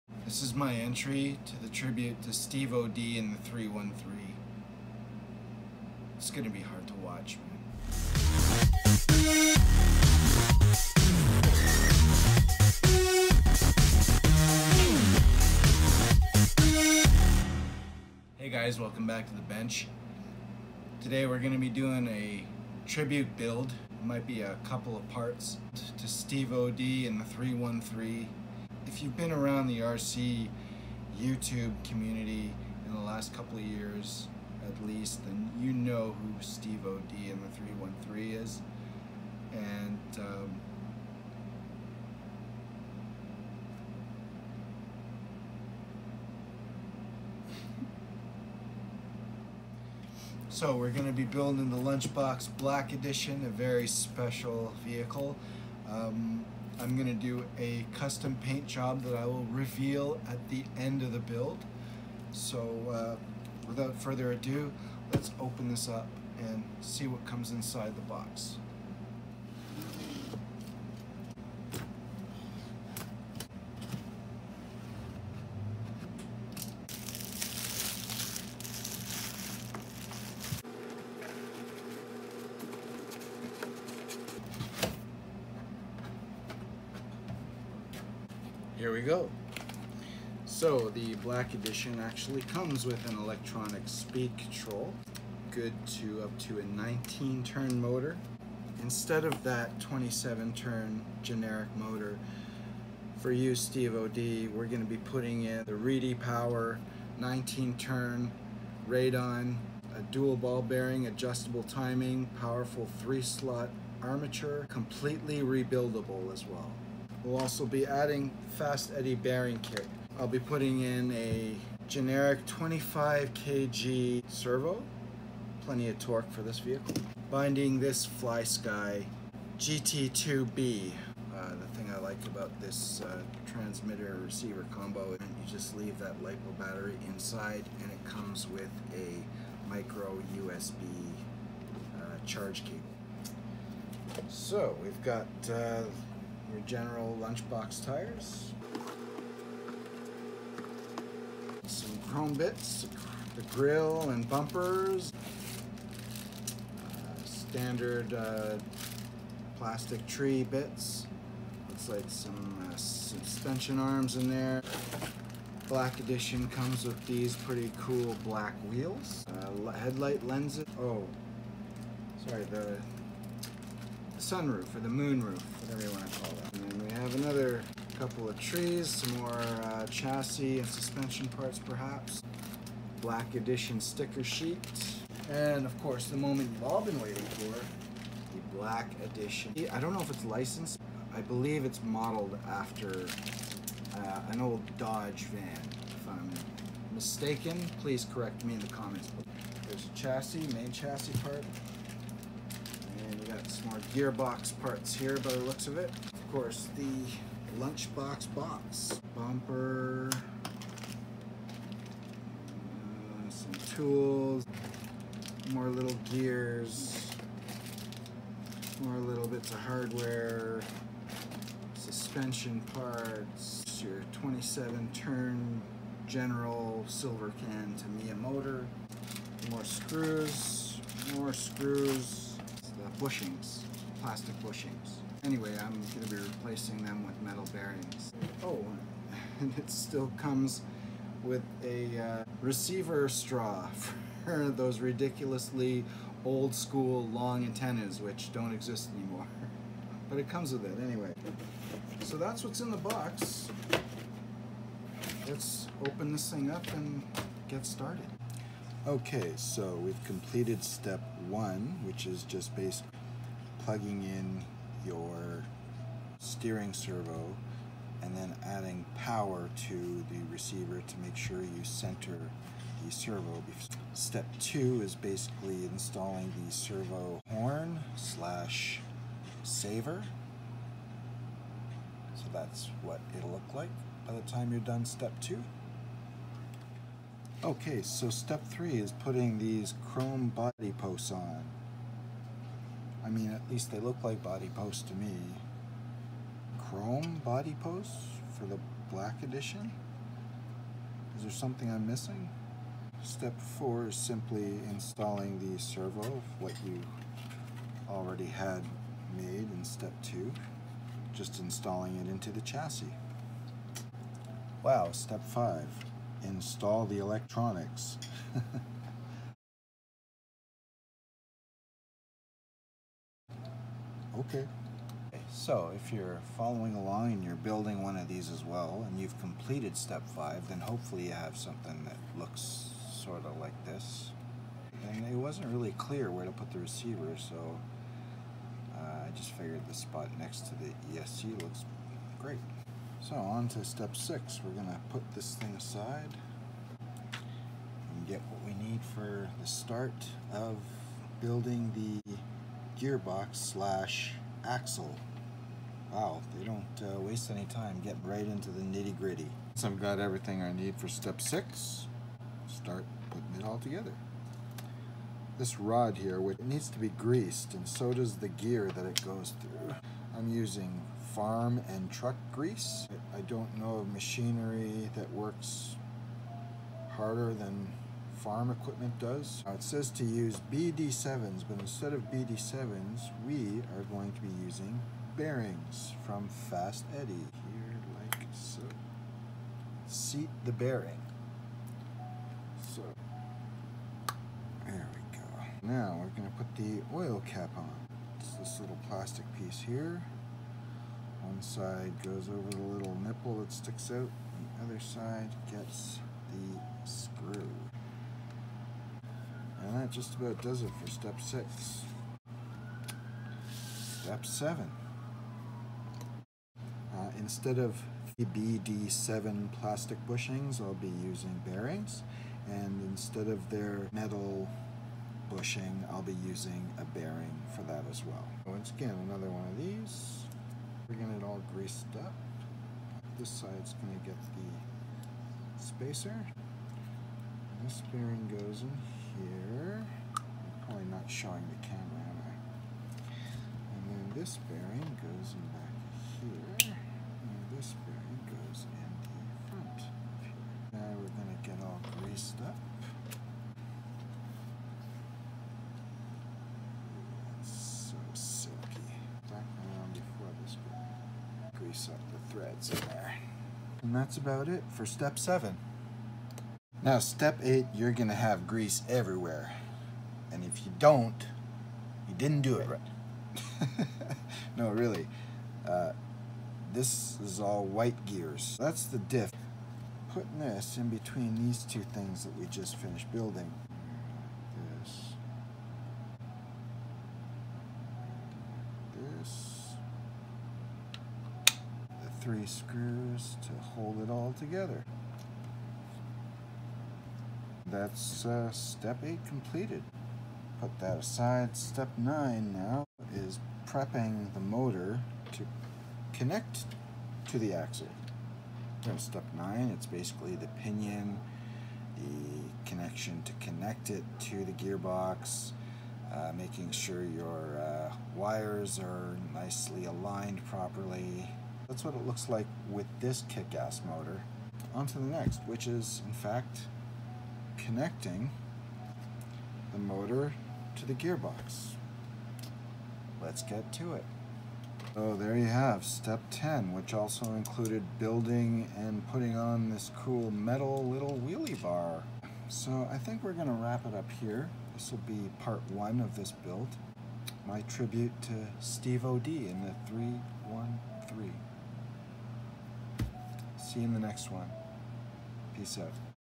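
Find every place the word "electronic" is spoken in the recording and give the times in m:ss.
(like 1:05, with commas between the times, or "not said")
1:33, 5:16.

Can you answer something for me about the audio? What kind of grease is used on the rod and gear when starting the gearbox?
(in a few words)
farm and truck grease.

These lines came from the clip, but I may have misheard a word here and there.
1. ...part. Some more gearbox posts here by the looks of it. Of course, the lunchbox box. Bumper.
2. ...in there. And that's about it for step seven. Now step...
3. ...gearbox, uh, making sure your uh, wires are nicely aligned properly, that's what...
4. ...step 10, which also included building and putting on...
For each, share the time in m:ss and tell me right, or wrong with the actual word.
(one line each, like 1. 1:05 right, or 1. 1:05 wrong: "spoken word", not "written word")
1. 3:21 wrong: "parts", not "posts"
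2. 7:42 right
3. 8:34 right
4. 8:55 right.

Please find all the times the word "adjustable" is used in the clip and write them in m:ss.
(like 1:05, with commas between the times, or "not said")
1:51.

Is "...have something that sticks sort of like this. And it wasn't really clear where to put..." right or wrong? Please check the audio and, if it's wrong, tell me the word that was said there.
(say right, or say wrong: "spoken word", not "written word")
wrong: "looks", not "sticks".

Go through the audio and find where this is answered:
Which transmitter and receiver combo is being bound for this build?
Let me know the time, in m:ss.
2:08.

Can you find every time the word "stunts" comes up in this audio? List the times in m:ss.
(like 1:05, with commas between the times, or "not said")
not said.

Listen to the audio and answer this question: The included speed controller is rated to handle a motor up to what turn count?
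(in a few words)
19 turn.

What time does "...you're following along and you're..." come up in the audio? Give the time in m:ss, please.
5:25.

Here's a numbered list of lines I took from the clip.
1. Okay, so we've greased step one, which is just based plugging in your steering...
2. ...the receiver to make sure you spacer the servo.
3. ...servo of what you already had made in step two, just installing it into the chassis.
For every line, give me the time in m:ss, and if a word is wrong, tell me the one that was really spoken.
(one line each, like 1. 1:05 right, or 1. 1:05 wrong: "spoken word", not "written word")
1. 4:18 wrong: "completed", not "greased"
2. 4:30 wrong: "center", not "spacer"
3. 5:05 right.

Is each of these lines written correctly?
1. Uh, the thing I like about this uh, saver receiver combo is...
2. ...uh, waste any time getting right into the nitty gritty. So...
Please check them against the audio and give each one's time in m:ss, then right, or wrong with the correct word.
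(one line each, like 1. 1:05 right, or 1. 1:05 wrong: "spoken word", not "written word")
1. 2:11 wrong: "transmitter", not "saver"
2. 5:56 right.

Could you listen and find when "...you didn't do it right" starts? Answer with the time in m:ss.
7:52.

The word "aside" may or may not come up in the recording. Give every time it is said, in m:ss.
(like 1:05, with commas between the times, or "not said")
5:45, 8:20.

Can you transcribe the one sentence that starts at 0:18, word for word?
Hey guys, welcome back to the bench.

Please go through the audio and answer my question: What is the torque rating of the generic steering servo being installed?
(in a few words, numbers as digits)
25 kg.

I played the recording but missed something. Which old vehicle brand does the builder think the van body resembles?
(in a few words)
Dodge.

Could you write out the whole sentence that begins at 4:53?
I mean, at least they look like body posts to me.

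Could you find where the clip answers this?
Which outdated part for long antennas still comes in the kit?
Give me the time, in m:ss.
4:02.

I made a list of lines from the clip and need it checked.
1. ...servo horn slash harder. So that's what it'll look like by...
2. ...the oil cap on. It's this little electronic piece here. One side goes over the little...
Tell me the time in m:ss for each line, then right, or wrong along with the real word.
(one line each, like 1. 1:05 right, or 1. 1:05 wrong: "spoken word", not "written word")
1. 4:36 wrong: "saver", not "harder"
2. 6:36 wrong: "plastic", not "electronic".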